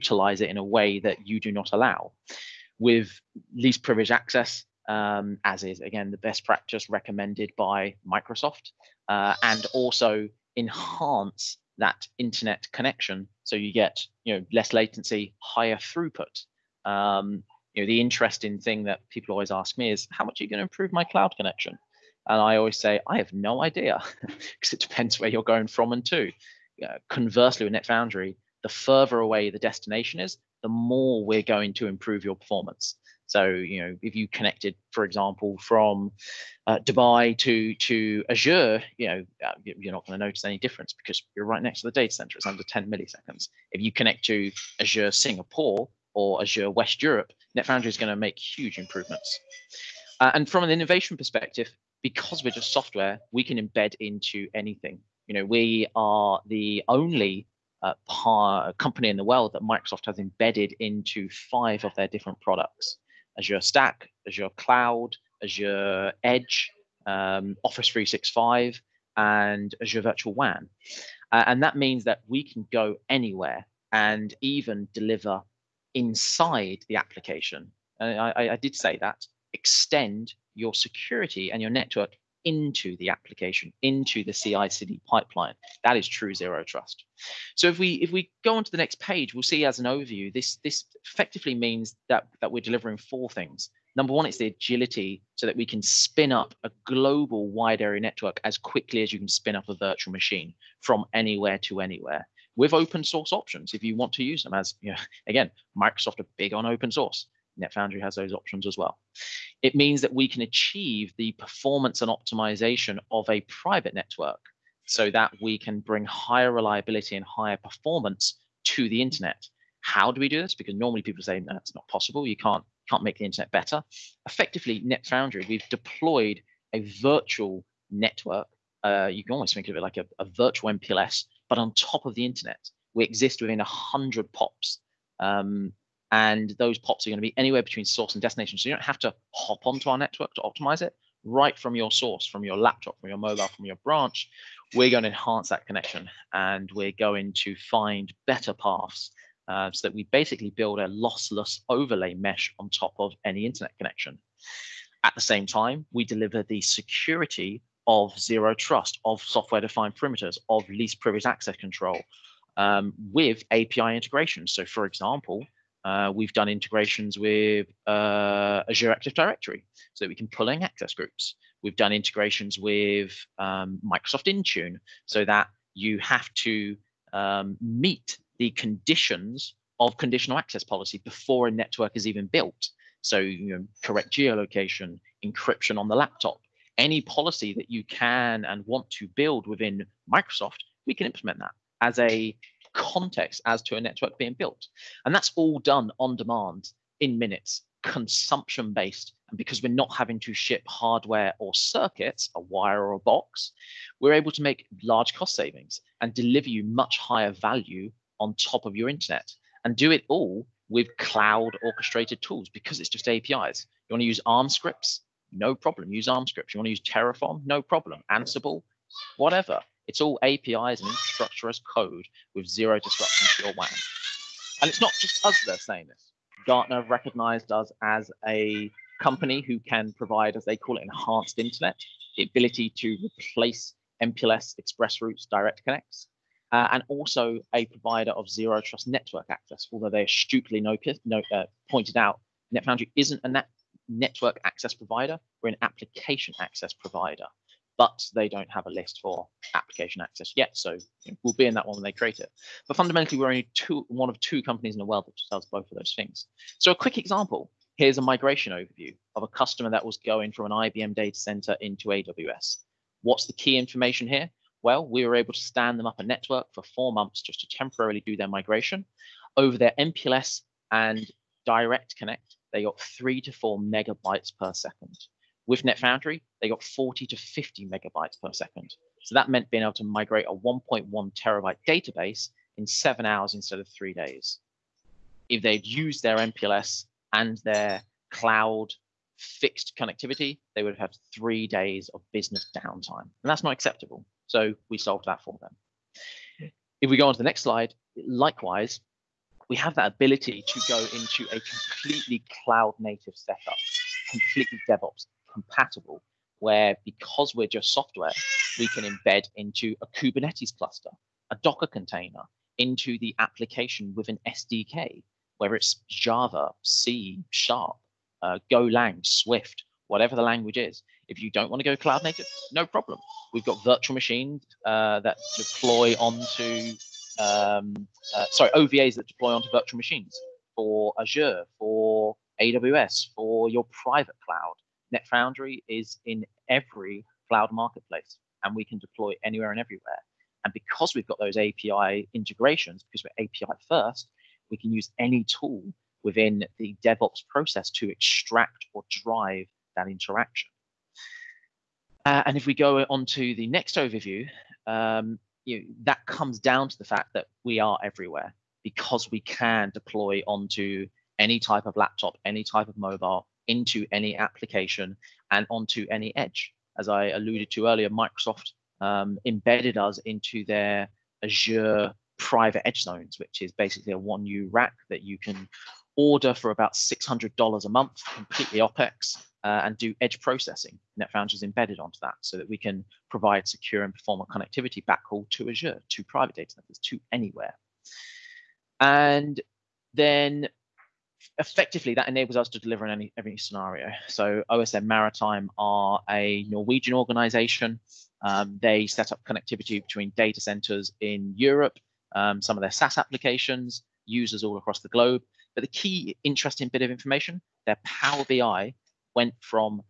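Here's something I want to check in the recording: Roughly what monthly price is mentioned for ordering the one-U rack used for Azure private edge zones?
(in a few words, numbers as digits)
$600.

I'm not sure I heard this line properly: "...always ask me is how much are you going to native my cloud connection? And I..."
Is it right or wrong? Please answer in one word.
wrong.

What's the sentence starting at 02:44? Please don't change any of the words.
So, for example, uh, we've done integrations with uh, Azure Active Directory so that we can pull in access groups.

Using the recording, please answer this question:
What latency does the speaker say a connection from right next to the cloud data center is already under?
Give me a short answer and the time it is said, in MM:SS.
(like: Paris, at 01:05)
10 milliseconds, at 00:42.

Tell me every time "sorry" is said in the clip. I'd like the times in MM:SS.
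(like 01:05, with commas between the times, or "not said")
05:28.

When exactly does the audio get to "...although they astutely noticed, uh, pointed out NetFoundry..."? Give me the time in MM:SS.
03:59.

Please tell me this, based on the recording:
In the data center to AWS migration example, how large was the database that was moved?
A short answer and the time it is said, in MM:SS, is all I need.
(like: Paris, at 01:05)
1.1 terabytes, at 04:40.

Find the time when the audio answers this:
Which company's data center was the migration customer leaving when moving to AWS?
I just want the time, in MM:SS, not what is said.
04:20.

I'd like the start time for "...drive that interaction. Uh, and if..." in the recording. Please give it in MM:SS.
05:48.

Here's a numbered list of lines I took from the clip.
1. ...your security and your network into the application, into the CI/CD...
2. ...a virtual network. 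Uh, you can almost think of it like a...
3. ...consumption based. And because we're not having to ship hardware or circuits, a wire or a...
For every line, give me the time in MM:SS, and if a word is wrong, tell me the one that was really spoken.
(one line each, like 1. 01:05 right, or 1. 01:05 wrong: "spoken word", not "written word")
1. 01:20 right
2. 02:06 right
3. 03:17 right.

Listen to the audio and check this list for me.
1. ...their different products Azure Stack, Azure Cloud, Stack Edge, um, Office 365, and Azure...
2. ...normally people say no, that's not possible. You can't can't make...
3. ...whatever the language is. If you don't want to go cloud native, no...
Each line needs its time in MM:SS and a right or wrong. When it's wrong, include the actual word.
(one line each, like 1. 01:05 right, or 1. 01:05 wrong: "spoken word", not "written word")
1. 01:01 wrong: "Azure", not "Stack"
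2. 02:00 right
3. 05:19 right.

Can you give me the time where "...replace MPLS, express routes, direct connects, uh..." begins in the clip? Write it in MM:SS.
03:53.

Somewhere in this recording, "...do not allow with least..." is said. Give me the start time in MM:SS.
00:01.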